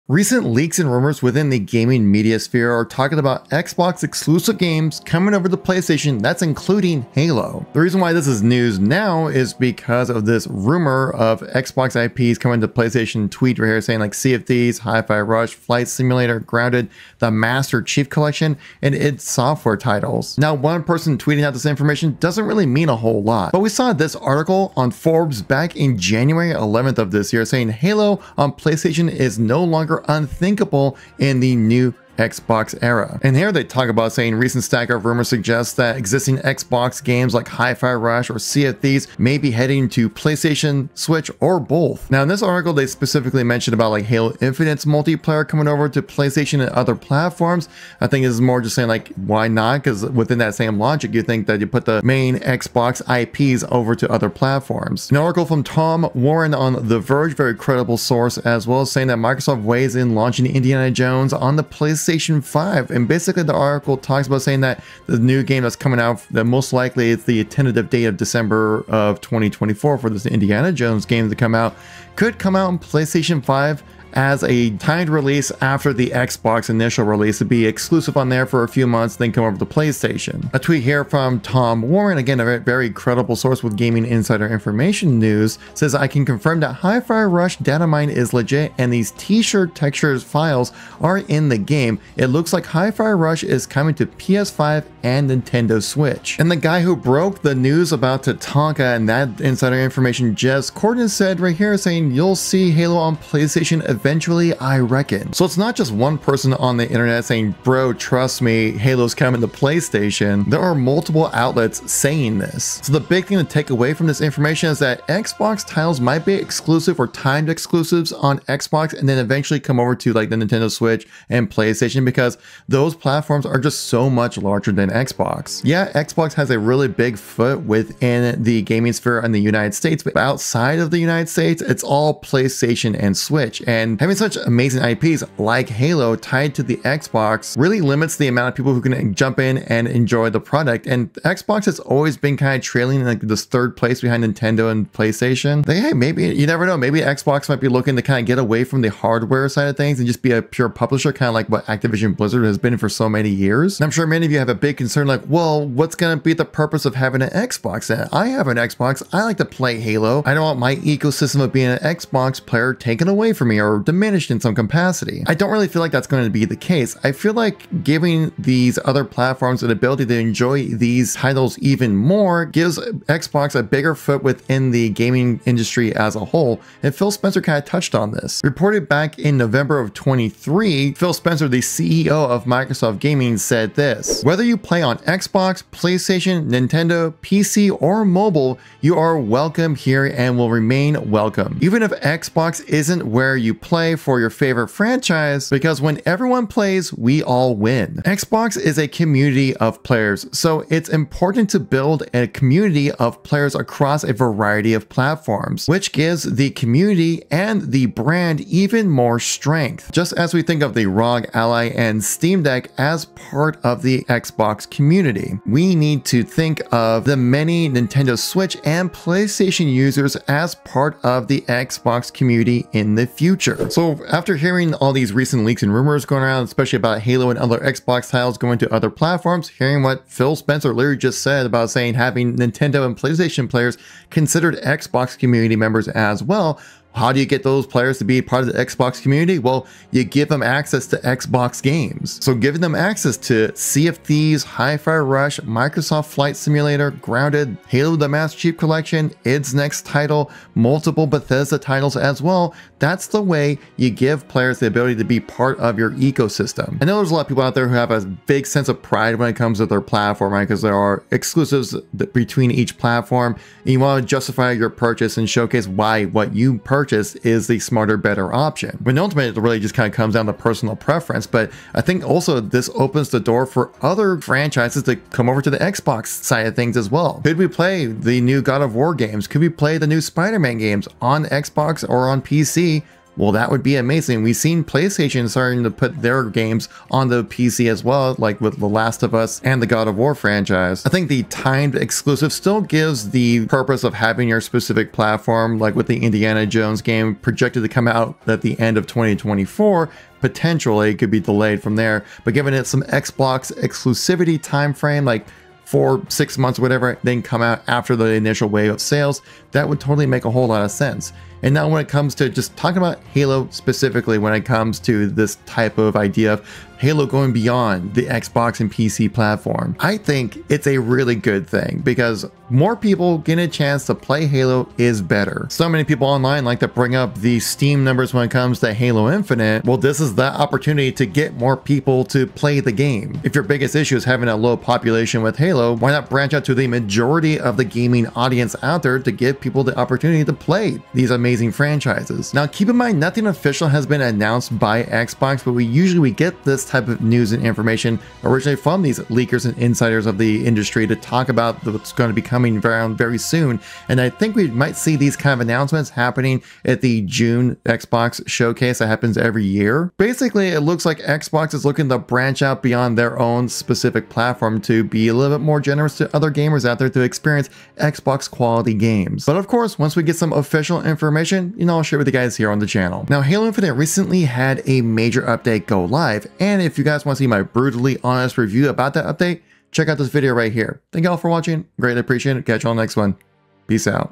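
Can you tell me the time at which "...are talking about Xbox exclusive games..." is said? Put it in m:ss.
0:02.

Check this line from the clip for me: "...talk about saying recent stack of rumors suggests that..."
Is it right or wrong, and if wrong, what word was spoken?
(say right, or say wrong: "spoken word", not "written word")
right.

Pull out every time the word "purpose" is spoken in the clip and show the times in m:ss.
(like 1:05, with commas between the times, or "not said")
2:36, 4:53.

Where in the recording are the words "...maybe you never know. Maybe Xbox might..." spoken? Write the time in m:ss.
2:25.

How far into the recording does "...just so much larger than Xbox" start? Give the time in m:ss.
2:03.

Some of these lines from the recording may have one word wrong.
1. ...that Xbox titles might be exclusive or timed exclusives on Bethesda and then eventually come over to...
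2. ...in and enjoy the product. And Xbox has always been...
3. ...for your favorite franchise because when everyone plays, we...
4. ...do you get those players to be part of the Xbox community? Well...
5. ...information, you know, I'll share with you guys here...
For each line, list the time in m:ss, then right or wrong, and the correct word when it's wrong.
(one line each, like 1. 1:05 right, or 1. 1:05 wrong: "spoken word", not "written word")
1. 1:54 wrong: "Xbox", not "Bethesda"
2. 2:19 right
3. 3:13 right
4. 3:57 right
5. 6:11 right.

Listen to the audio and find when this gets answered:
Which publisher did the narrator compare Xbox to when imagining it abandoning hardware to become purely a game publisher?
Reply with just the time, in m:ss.
2:31.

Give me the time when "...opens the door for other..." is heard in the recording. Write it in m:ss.
4:32.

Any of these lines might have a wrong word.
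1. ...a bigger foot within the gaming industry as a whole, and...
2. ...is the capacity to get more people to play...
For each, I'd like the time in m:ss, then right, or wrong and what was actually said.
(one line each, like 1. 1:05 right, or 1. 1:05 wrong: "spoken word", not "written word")
1. 2:53 right
2. 5:29 wrong: "opportunity", not "capacity".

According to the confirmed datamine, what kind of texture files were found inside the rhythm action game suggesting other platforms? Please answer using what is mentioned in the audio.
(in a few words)
t-shirt textures.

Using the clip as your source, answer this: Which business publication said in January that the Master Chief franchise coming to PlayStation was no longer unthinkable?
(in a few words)
Forbes.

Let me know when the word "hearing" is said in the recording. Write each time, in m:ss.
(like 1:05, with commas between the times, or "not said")
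3:44, 3:49.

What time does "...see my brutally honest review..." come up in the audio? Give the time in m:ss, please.
6:17.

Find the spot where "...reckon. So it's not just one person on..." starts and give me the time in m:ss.
1:44.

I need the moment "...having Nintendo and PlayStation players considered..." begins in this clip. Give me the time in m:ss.
3:51.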